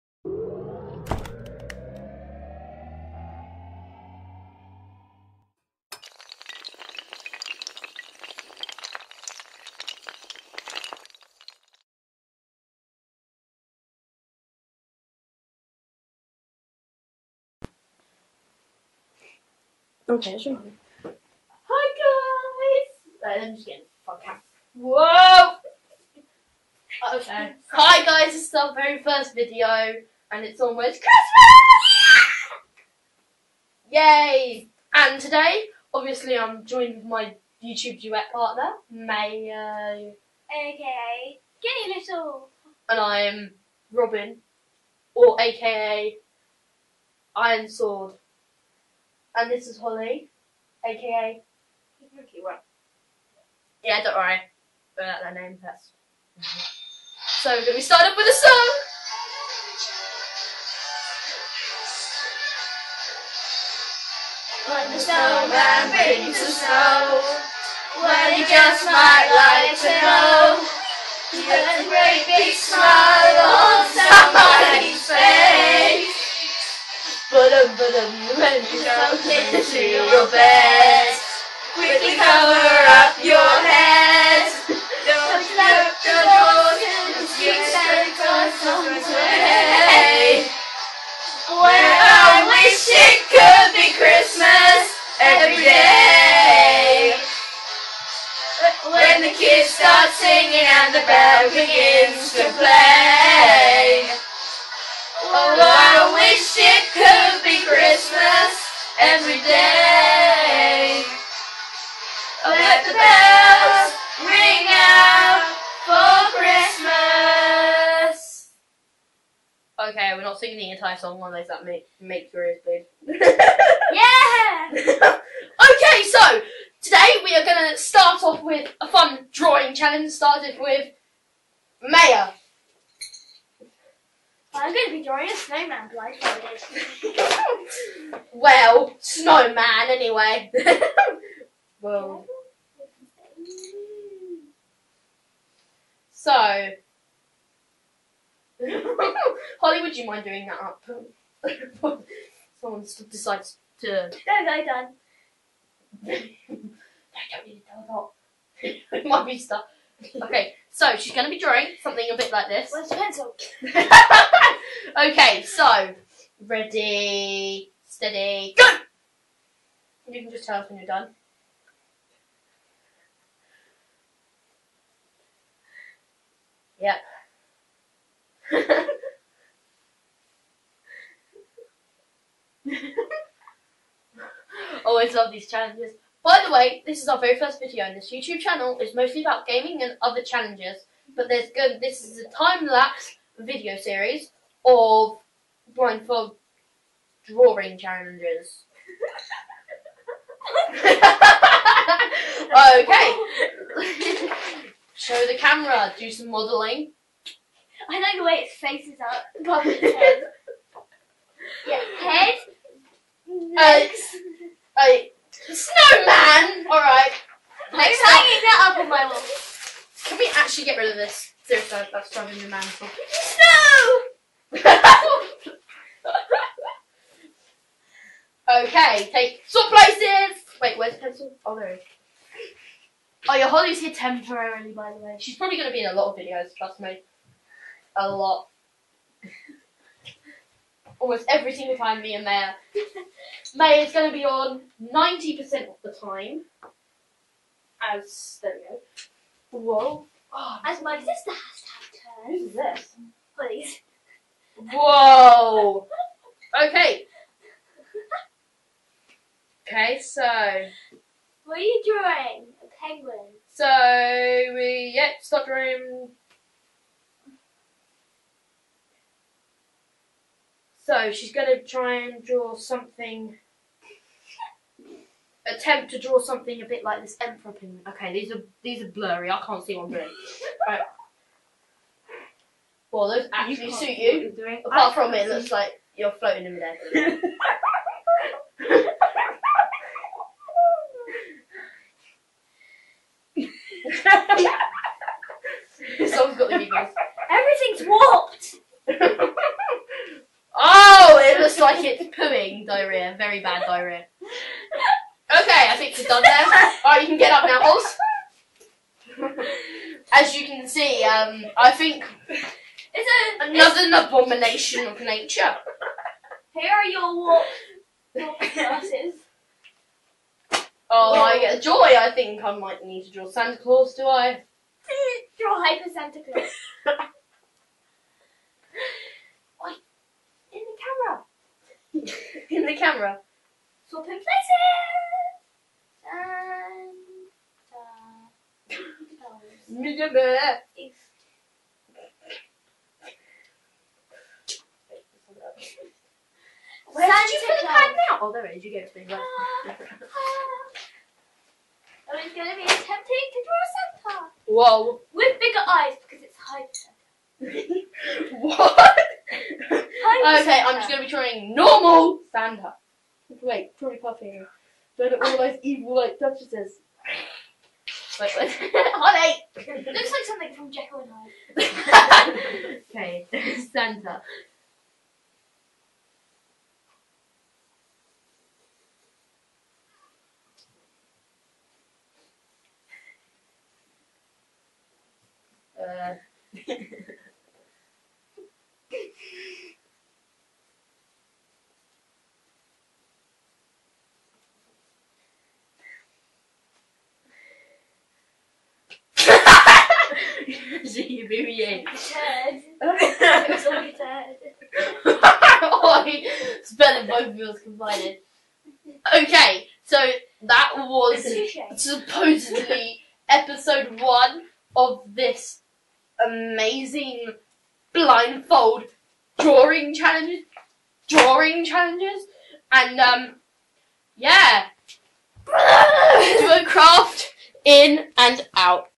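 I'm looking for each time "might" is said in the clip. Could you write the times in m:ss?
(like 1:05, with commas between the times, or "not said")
1:08, 2:39, 5:22.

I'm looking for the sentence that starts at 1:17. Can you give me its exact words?
Ba-dum, ba-dum, when you jump into your bed, quickly cover up your head.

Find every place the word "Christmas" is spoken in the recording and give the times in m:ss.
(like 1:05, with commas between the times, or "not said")
0:31, 1:33, 1:56.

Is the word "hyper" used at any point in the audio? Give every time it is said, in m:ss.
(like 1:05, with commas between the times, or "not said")
5:25, 5:56.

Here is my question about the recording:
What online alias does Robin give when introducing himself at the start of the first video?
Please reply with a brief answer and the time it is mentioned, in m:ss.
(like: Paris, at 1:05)
Iron Sword, at 0:47.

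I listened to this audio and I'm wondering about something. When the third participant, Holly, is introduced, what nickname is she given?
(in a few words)
Pinky One.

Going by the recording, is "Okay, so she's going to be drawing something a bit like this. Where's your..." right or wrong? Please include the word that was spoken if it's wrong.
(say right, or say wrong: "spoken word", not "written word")
right.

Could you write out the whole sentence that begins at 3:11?
But there's good this is a time lapse video series of blindfold drawing challenges.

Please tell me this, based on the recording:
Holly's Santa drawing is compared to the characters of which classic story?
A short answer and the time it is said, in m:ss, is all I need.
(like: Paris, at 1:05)
Jekyll and Hyde, at 6:10.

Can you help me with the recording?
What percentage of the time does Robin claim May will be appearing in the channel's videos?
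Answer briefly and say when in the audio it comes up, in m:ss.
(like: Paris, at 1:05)
90%, at 4:04.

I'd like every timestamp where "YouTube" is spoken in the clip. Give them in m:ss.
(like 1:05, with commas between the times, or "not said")
0:37, 3:08.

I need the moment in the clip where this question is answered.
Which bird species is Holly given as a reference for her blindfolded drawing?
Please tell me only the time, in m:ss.
4:37.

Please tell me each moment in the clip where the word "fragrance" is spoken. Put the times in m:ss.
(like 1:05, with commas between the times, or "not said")
not said.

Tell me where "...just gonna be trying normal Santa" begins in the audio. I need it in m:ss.
6:00.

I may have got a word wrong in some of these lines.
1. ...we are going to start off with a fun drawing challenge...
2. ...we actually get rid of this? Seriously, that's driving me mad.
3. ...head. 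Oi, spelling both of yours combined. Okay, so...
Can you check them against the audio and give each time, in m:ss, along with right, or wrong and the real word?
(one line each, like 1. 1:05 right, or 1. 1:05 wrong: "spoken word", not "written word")
1. 2:07 right
2. 3:40 right
3. 6:44 right.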